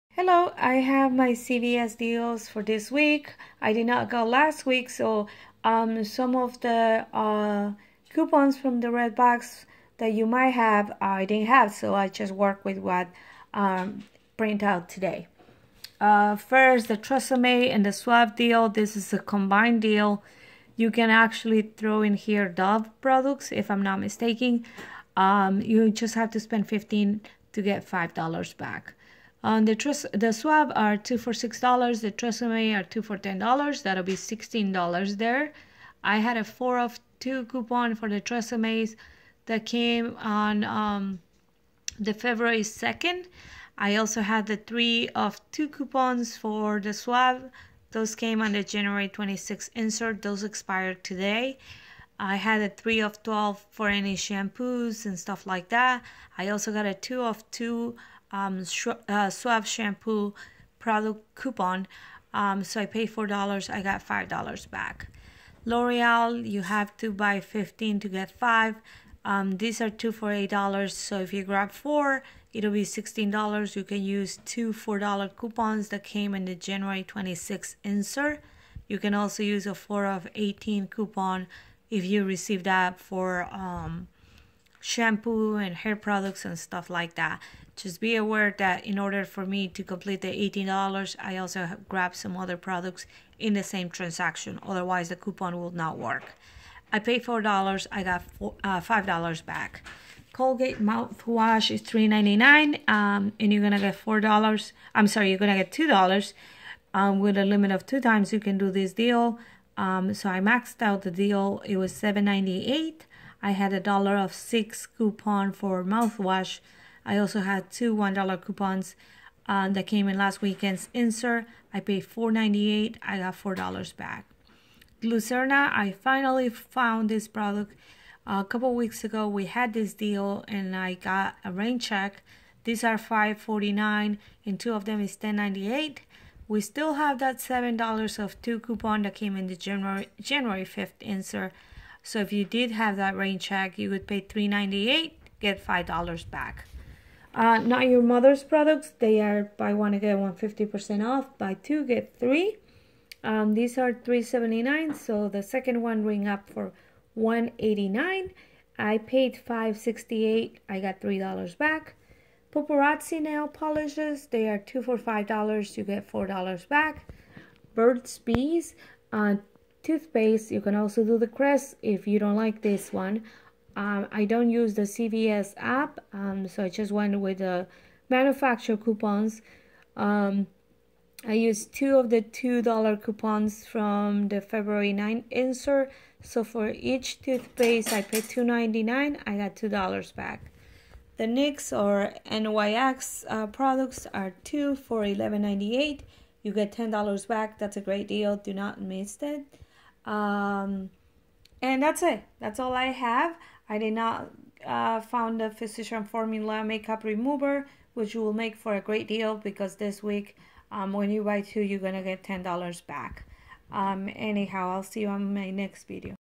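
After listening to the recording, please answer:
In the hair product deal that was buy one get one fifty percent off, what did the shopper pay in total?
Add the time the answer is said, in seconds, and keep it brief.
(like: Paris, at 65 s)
$5.68, at 159 s.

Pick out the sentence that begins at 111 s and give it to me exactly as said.
It was $7.98 I had a dollar of six coupon for mouthwash.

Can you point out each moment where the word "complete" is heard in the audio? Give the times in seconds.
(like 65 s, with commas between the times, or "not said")
89 s.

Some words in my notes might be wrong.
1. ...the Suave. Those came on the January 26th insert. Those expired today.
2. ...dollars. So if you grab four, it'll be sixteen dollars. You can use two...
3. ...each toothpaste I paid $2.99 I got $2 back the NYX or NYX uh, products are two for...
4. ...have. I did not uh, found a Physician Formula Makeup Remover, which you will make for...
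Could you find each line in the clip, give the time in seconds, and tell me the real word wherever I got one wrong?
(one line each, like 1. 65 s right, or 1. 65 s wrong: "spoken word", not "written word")
1. 46 s right
2. 70 s right
3. 186 s right
4. 202 s right.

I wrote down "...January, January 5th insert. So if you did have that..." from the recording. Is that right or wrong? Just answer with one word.
right.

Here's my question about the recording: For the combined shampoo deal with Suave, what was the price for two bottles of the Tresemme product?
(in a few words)
$10.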